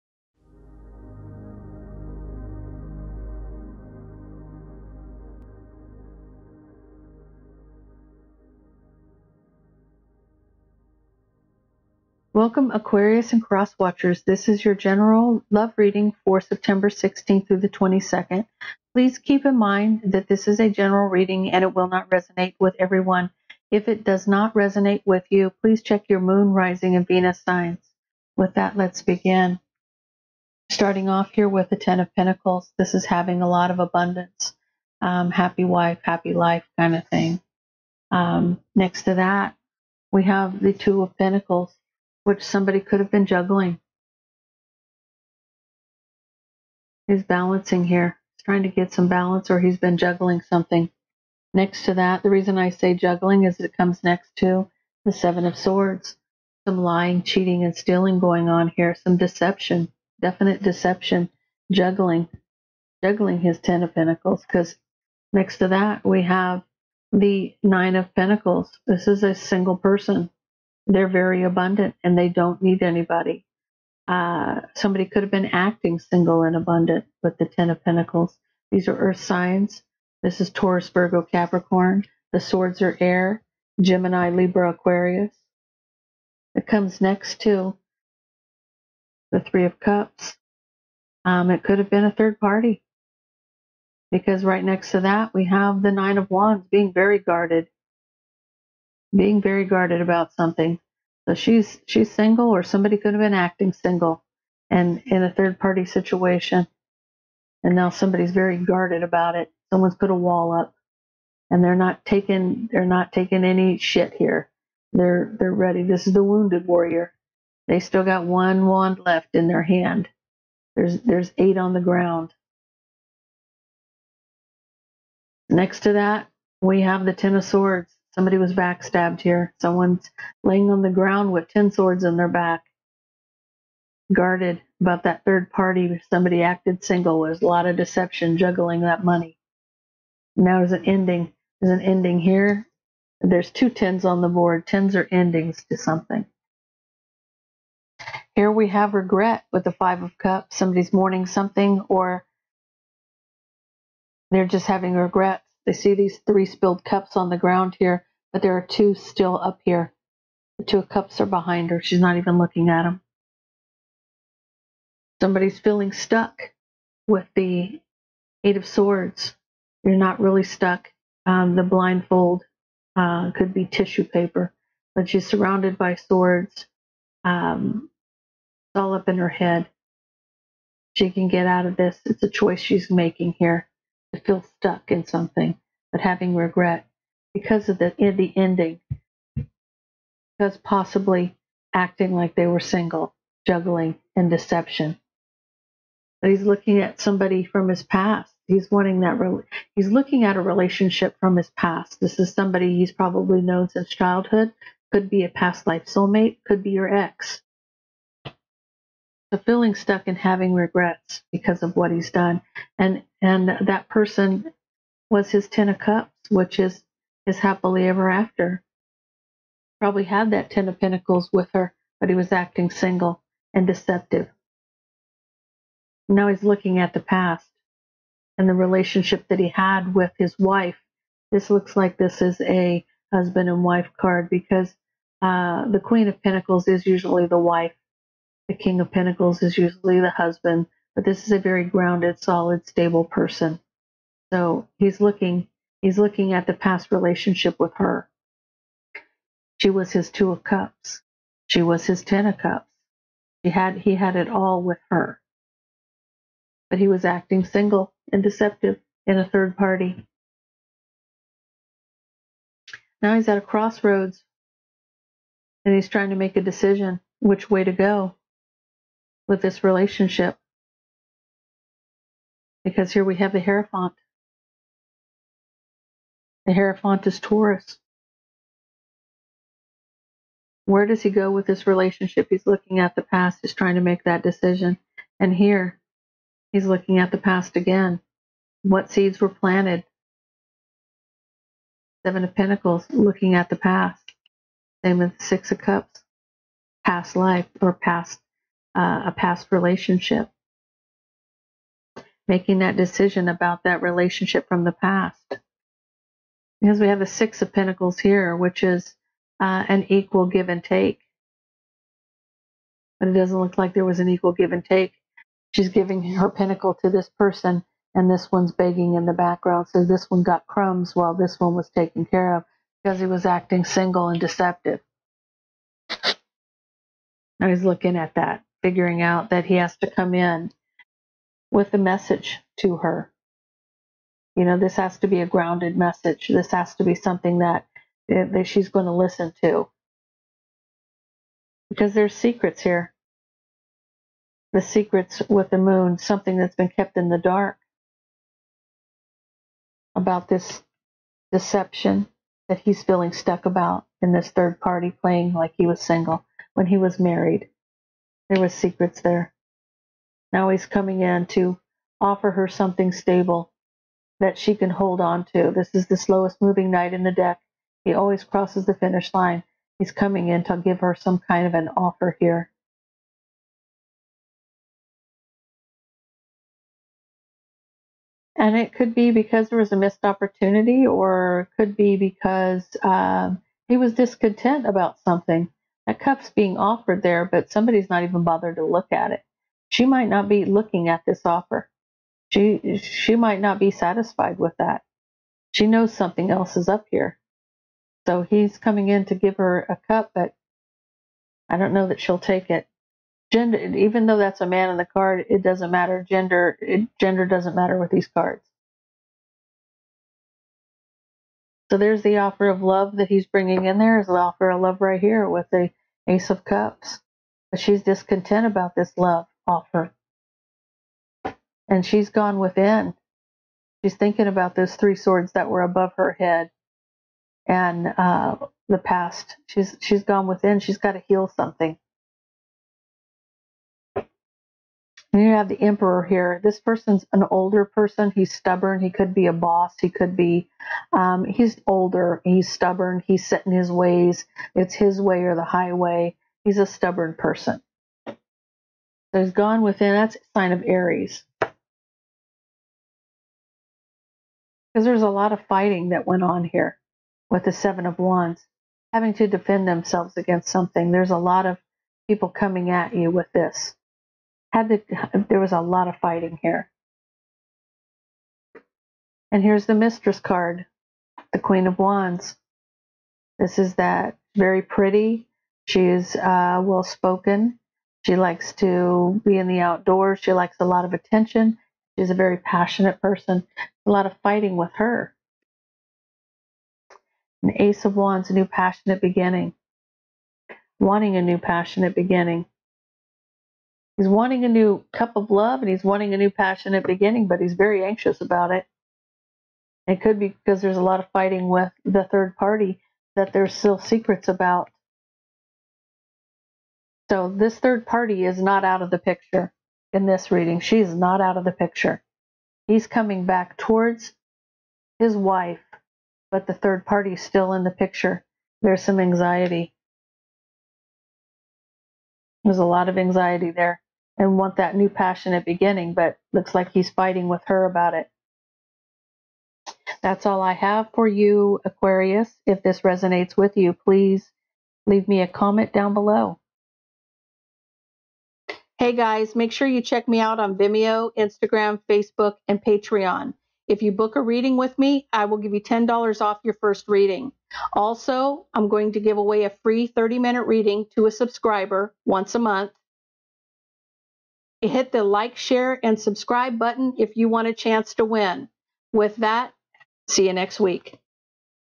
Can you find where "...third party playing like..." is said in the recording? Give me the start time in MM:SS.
05:54.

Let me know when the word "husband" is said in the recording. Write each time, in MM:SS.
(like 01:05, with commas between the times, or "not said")
03:53, 04:00.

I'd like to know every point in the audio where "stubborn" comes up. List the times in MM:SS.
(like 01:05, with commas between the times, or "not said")
07:18, 07:22, 07:26.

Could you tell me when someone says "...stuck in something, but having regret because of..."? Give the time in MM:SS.
03:04.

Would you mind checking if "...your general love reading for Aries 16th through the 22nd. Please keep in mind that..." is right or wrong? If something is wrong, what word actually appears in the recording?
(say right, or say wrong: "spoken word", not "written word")
wrong: "September", not "Aries".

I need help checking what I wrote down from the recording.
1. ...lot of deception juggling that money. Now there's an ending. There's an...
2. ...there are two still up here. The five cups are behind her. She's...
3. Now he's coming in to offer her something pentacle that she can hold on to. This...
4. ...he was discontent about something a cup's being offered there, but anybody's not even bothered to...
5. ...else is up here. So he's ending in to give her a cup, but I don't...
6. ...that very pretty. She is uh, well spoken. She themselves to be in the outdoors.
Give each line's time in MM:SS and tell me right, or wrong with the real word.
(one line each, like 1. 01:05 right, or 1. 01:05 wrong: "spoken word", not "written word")
1. 02:17 right
2. 02:38 wrong: "two", not "five"
3. 06:00 wrong: "stable", not "pentacle"
4. 06:23 wrong: "somebody", not "anybody"
5. 06:36 wrong: "coming", not "ending"
6. 07:53 wrong: "likes", not "themselves".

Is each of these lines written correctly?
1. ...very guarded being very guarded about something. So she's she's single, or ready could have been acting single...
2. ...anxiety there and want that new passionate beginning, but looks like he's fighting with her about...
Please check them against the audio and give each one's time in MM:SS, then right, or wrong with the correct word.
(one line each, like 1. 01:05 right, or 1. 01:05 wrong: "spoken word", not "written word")
1. 01:36 wrong: "somebody", not "ready"
2. 08:42 right.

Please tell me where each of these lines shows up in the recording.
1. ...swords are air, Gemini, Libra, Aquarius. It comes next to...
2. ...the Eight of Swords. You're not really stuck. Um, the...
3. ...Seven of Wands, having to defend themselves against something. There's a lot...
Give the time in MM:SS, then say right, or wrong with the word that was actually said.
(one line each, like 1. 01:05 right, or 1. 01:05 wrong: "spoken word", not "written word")
1. 01:22 right
2. 02:47 right
3. 07:37 right.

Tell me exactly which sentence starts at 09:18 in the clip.
With that, see you next week.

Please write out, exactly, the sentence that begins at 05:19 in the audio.
So this one got crumbs while this one was taken care of because he was acting single and deceptive.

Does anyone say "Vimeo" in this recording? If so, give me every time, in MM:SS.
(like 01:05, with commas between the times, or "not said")
09:00.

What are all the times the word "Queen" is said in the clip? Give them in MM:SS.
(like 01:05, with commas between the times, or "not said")
03:55, 07:51.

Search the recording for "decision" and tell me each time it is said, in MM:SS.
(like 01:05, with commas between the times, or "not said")
04:26, 04:44, 05:02.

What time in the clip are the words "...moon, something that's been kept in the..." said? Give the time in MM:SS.
05:45.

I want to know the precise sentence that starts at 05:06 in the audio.
Because we have the Six of Pentacles here, which is uh, an equal give and take.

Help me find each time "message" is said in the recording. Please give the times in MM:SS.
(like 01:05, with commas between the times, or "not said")
05:31, 05:35.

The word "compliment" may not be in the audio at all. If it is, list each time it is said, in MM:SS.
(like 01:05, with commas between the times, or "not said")
not said.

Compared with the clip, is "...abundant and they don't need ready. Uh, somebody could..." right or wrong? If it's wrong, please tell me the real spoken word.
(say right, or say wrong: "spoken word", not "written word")
wrong: "anybody", not "ready".